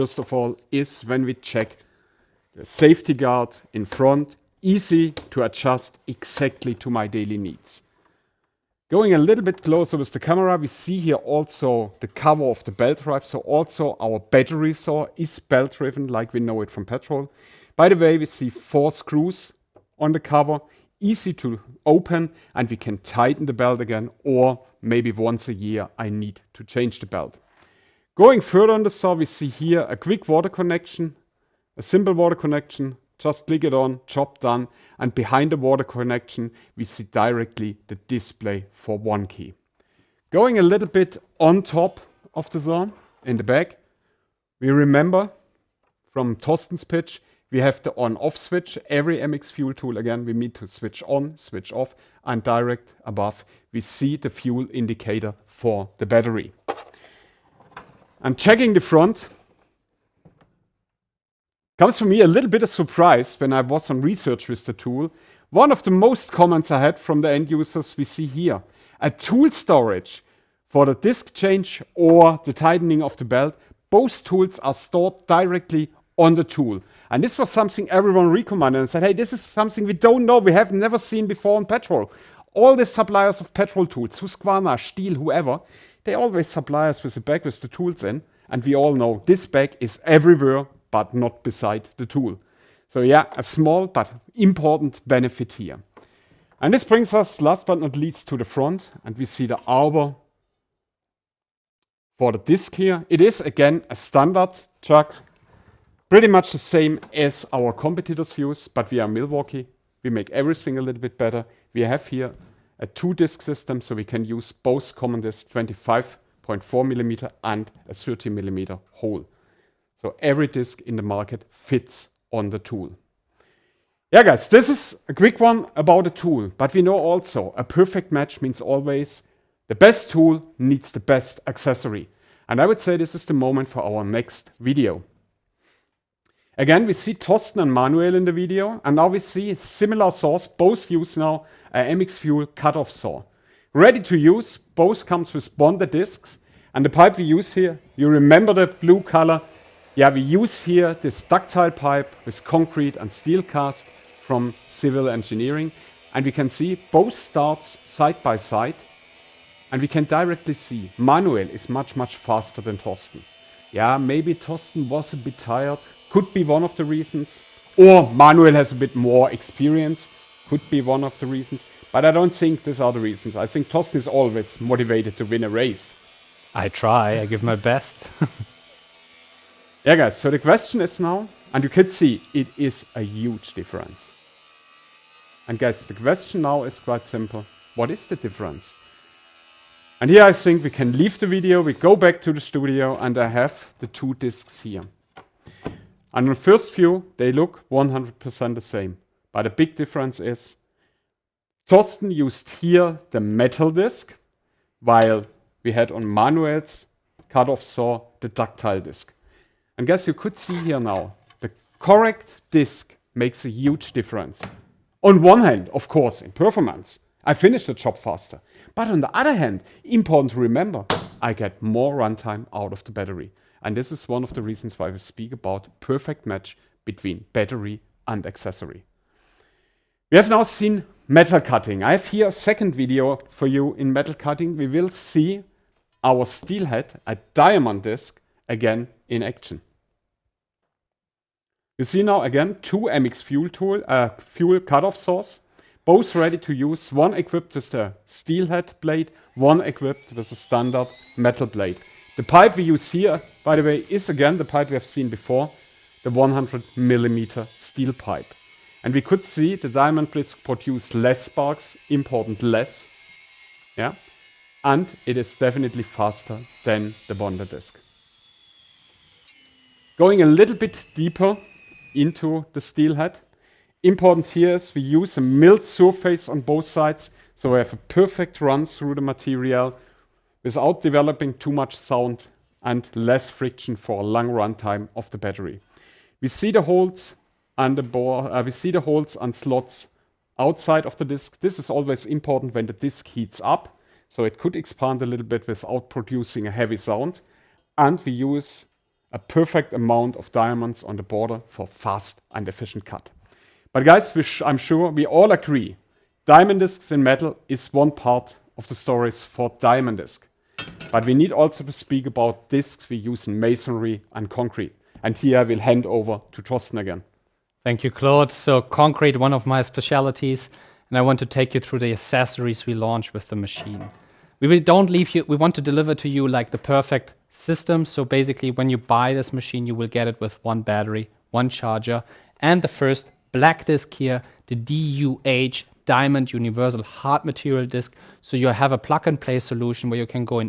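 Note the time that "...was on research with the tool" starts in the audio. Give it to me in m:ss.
1:03.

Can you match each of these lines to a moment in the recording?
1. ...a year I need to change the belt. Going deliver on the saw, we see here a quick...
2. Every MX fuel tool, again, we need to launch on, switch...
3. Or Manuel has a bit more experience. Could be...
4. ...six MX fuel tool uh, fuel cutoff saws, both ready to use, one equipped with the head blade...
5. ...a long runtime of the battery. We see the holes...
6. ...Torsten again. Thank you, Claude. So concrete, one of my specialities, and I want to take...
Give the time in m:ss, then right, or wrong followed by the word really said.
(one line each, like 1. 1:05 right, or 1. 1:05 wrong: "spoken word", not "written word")
1. 0:25 wrong: "further", not "deliver"
2. 0:48 wrong: "switch", not "launch"
3. 2:47 right
4. 4:02 wrong: "two", not "six"
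5. 4:43 right
6. 5:16 right.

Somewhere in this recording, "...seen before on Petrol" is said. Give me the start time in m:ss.
1:20.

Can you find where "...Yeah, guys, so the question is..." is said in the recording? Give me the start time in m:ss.
2:59.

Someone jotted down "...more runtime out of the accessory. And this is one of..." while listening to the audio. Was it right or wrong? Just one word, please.
wrong.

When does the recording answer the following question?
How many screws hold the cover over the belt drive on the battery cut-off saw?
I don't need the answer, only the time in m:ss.
0:18.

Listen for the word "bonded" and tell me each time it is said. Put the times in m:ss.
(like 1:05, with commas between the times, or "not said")
2:25, 4:27.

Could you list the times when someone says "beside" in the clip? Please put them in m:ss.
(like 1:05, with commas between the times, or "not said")
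1:31.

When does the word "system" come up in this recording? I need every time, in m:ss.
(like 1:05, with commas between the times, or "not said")
1:53, 5:27.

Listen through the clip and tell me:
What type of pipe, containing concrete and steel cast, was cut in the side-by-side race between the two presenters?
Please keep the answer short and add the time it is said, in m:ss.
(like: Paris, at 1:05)
ductile pipe, at 2:31.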